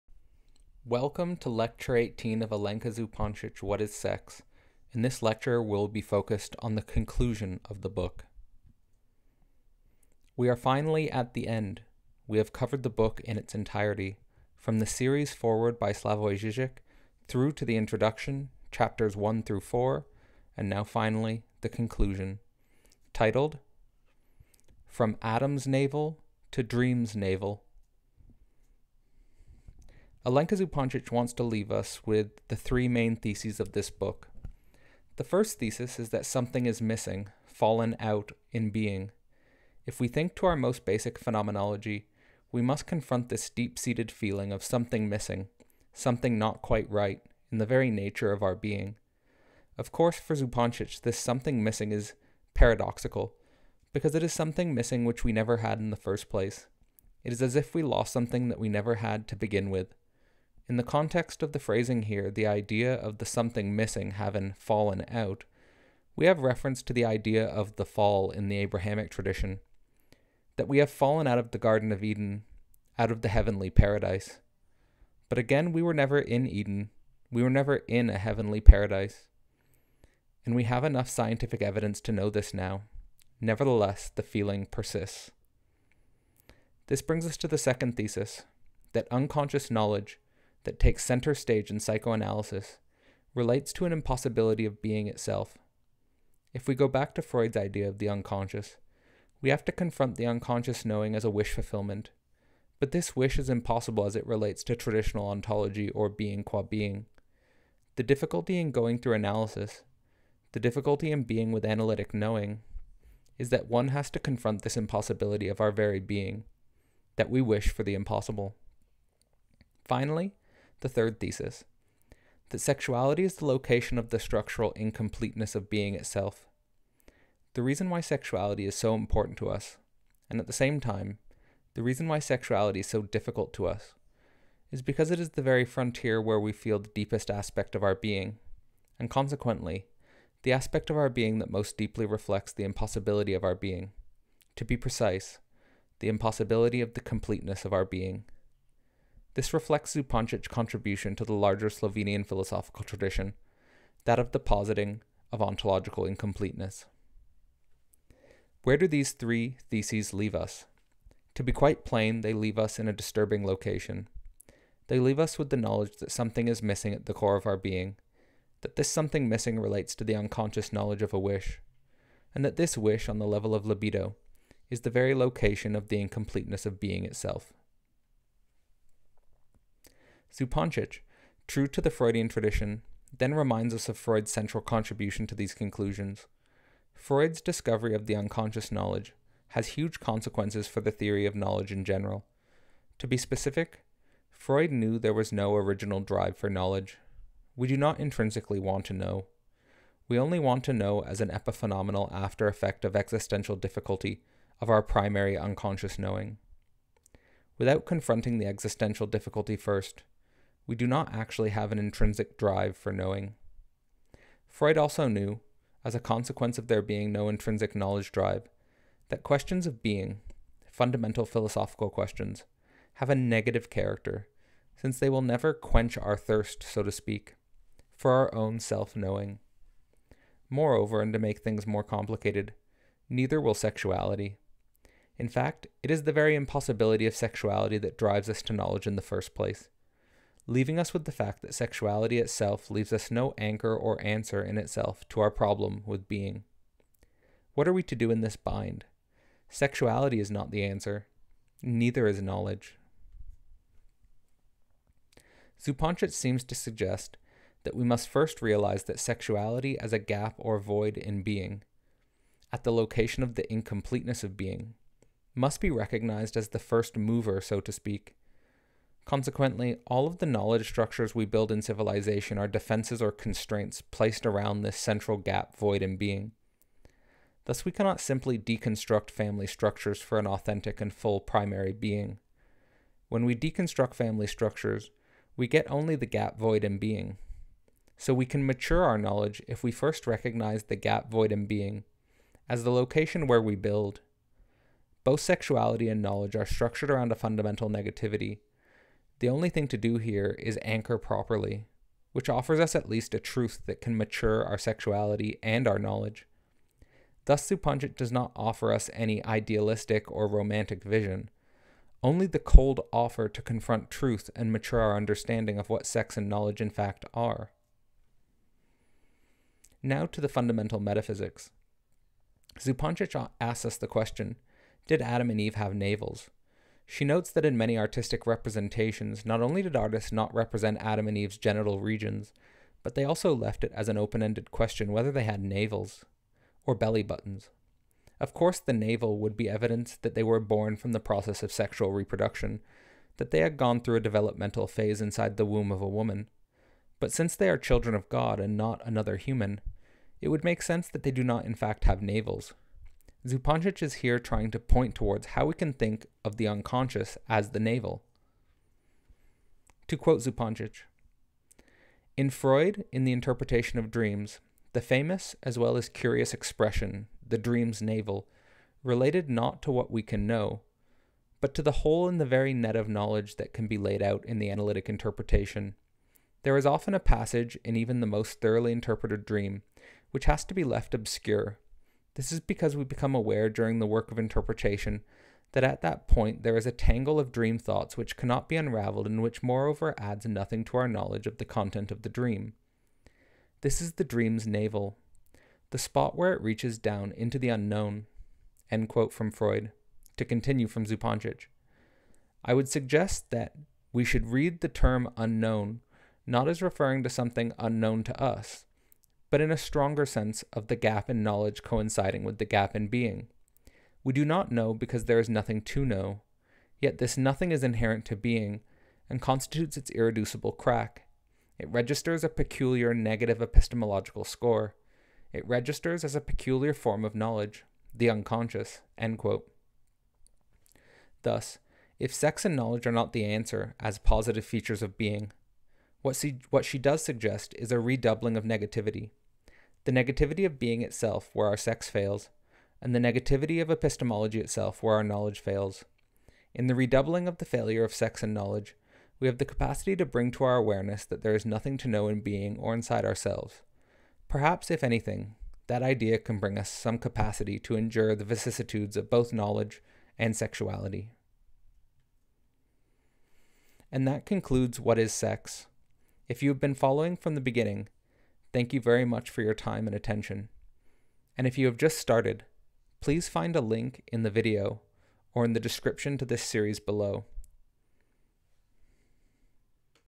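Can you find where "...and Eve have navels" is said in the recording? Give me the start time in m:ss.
5:25.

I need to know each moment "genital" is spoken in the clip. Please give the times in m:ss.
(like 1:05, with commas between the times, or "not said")
5:31.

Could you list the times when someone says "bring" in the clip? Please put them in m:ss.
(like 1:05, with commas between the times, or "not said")
1:27, 7:30, 7:36.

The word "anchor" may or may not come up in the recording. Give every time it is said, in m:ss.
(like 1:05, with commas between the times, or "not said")
4:03, 5:00.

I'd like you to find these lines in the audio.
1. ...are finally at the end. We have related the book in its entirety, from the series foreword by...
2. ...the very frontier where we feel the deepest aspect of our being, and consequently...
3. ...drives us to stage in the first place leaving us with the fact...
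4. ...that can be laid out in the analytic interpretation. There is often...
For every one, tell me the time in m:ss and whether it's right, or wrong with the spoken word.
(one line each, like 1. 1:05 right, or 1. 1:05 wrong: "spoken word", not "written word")
1. 0:10 wrong: "covered", not "related"
2. 2:15 right
3. 3:57 wrong: "knowledge", not "stage"
4. 6:13 right.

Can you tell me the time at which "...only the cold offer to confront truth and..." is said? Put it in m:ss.
5:12.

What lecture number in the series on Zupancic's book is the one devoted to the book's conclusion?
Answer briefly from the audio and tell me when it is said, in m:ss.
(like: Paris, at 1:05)
18, at 0:01.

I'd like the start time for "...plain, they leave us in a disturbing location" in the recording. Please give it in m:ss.
2:41.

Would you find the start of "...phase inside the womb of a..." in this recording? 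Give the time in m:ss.
5:44.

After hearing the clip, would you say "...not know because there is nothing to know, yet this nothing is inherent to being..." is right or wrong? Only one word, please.
right.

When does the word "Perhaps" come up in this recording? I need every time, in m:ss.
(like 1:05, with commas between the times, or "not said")
7:34.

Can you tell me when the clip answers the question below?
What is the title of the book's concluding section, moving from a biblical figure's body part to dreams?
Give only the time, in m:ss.
0:24.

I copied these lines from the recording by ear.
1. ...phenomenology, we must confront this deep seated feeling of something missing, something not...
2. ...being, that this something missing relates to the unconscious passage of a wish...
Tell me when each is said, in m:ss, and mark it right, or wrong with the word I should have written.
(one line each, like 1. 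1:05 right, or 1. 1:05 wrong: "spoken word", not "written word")
1. 0:41 right
2. 2:47 wrong: "knowledge", not "passage".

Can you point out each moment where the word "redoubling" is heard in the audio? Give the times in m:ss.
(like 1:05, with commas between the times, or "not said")
7:17, 7:26.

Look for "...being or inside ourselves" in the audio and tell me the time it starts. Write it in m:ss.
7:32.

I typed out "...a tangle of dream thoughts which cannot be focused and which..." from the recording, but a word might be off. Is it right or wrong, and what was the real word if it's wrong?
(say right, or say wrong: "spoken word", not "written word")
wrong: "unraveled", not "focused".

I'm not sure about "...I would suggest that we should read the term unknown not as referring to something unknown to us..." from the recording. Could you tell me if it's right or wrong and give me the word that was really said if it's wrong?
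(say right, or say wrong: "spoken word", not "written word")
right.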